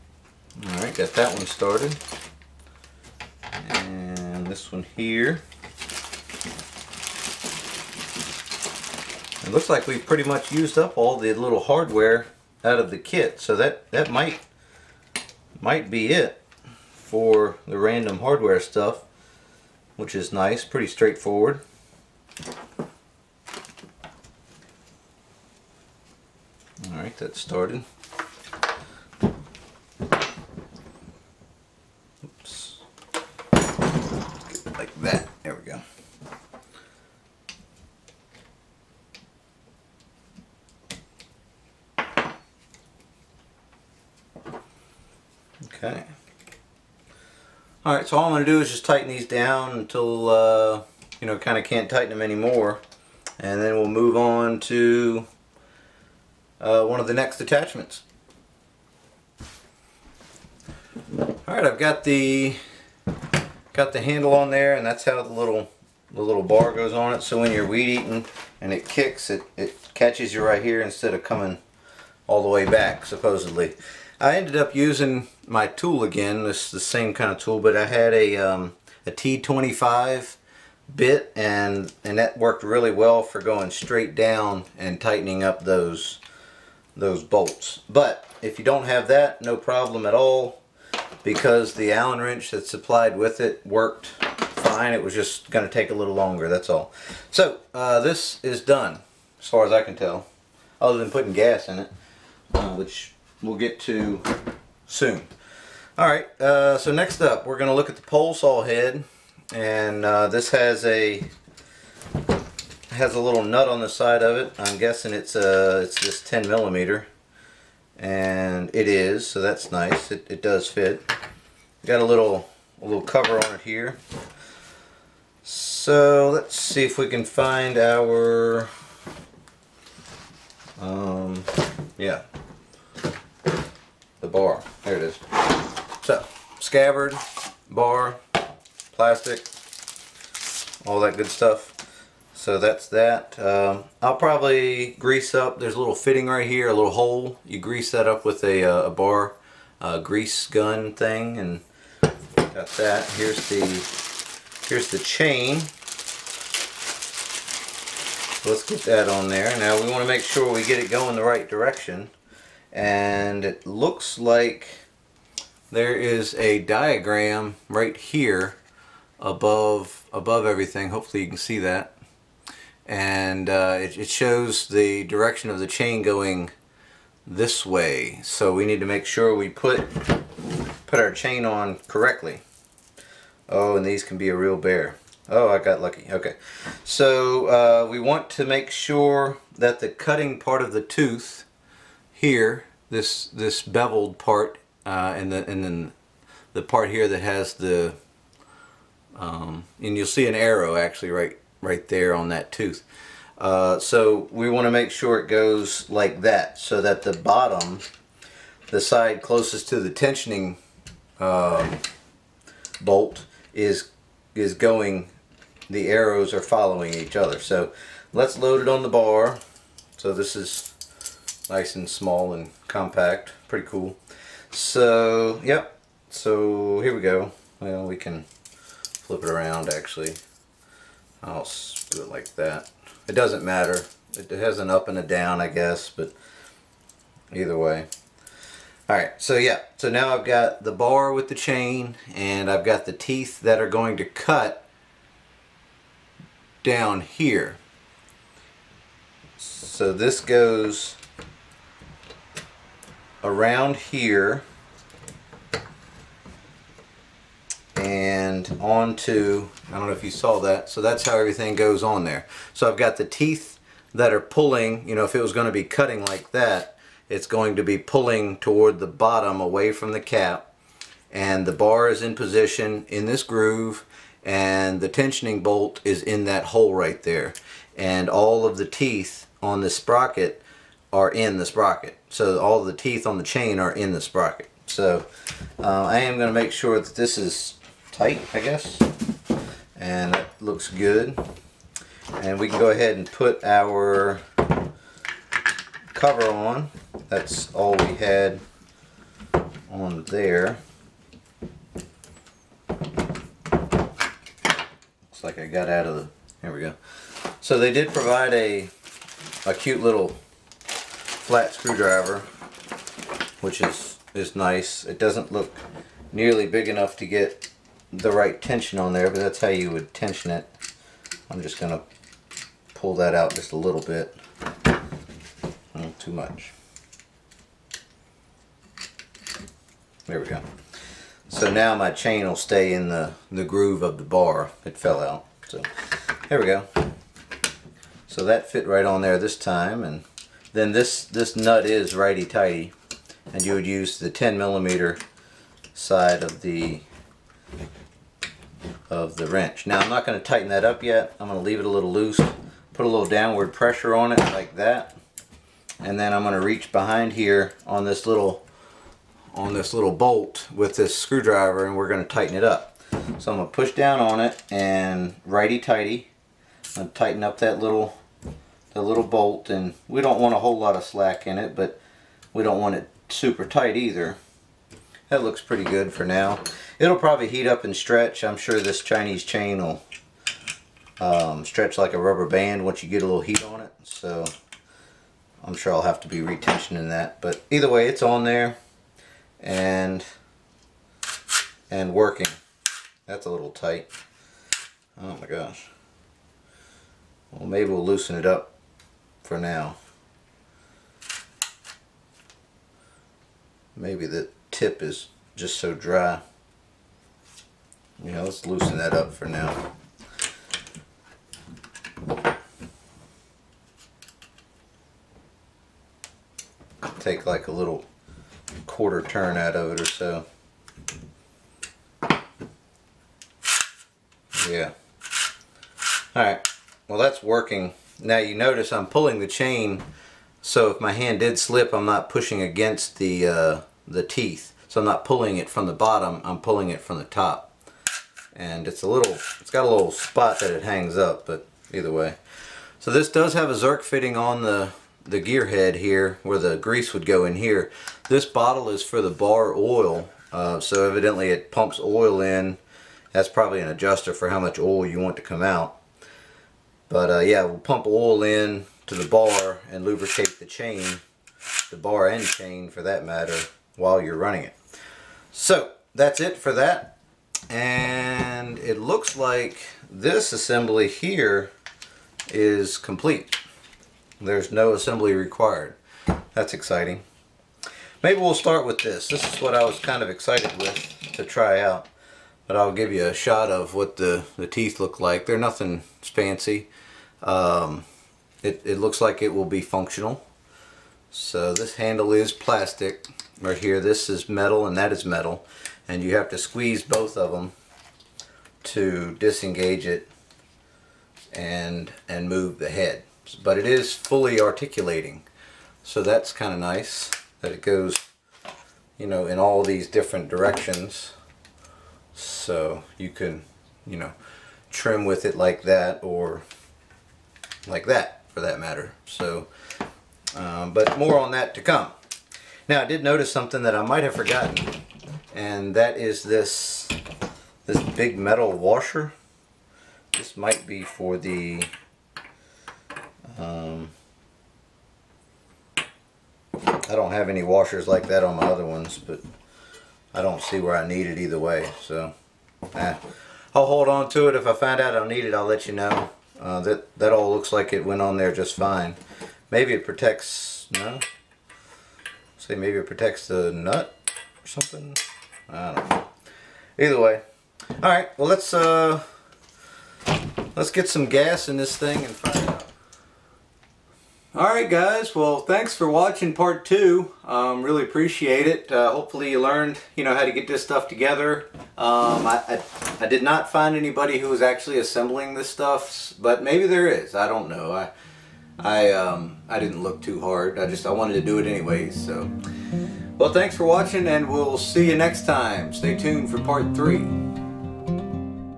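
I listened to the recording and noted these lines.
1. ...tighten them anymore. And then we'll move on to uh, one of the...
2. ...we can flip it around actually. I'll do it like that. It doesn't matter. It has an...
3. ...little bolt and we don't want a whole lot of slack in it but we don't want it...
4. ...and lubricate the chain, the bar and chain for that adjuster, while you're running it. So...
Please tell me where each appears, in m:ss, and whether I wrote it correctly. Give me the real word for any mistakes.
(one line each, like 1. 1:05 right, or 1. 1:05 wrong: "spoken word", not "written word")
1. 0:51 right
2. 3:47 right
3. 6:08 right
4. 7:39 wrong: "matter", not "adjuster".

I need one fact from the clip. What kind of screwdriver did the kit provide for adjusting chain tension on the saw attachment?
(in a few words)
flat screwdriver.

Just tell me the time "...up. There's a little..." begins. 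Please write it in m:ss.
2:25.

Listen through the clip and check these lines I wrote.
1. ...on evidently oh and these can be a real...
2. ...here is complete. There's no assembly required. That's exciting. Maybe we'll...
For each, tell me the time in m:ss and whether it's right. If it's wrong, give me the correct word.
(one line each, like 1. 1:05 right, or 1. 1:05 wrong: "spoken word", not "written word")
1. 3:01 wrong: "correctly", not "evidently"
2. 7:50 right.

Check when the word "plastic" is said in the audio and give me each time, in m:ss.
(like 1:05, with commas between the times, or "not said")
2:18, 8:12.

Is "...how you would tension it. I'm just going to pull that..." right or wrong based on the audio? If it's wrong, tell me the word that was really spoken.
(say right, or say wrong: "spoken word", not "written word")
right.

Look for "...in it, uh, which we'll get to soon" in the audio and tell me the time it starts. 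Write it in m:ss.
1:41.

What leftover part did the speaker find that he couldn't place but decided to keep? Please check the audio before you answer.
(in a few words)
big metal washer.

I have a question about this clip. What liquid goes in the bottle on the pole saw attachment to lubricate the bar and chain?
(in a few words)
bar oil.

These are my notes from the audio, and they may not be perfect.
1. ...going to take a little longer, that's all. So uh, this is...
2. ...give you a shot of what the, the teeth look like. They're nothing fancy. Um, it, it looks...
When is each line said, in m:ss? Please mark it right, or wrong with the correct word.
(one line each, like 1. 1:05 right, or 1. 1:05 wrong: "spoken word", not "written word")
1. 1:35 right
2. 8:02 right.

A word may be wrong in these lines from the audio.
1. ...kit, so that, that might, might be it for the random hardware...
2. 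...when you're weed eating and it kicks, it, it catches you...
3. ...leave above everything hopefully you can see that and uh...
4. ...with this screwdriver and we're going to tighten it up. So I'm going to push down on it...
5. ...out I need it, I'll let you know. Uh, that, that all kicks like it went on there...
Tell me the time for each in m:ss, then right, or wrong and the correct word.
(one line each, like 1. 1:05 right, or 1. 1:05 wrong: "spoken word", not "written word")
1. 0:12 right
2. 1:07 right
3. 2:49 wrong: "above", not "leave"
4. 6:00 right
5. 9:04 wrong: "looks", not "kicks".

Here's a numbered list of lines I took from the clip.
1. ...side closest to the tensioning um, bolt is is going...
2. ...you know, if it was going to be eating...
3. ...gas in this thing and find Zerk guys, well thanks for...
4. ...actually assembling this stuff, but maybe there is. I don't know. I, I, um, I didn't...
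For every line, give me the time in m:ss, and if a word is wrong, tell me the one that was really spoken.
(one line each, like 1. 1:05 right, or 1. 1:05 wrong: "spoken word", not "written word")
1. 3:28 right
2. 4:24 wrong: "cutting", not "eating"
3. 9:21 wrong: "Alright", not "Zerk"
4. 9:34 right.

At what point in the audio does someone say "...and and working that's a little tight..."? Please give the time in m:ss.
6:29.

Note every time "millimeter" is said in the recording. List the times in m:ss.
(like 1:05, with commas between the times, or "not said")
1:56, 5:44.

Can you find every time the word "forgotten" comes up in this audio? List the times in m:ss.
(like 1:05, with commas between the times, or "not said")
8:44.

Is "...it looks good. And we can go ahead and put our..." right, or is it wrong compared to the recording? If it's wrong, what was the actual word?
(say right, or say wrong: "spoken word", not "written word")
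right.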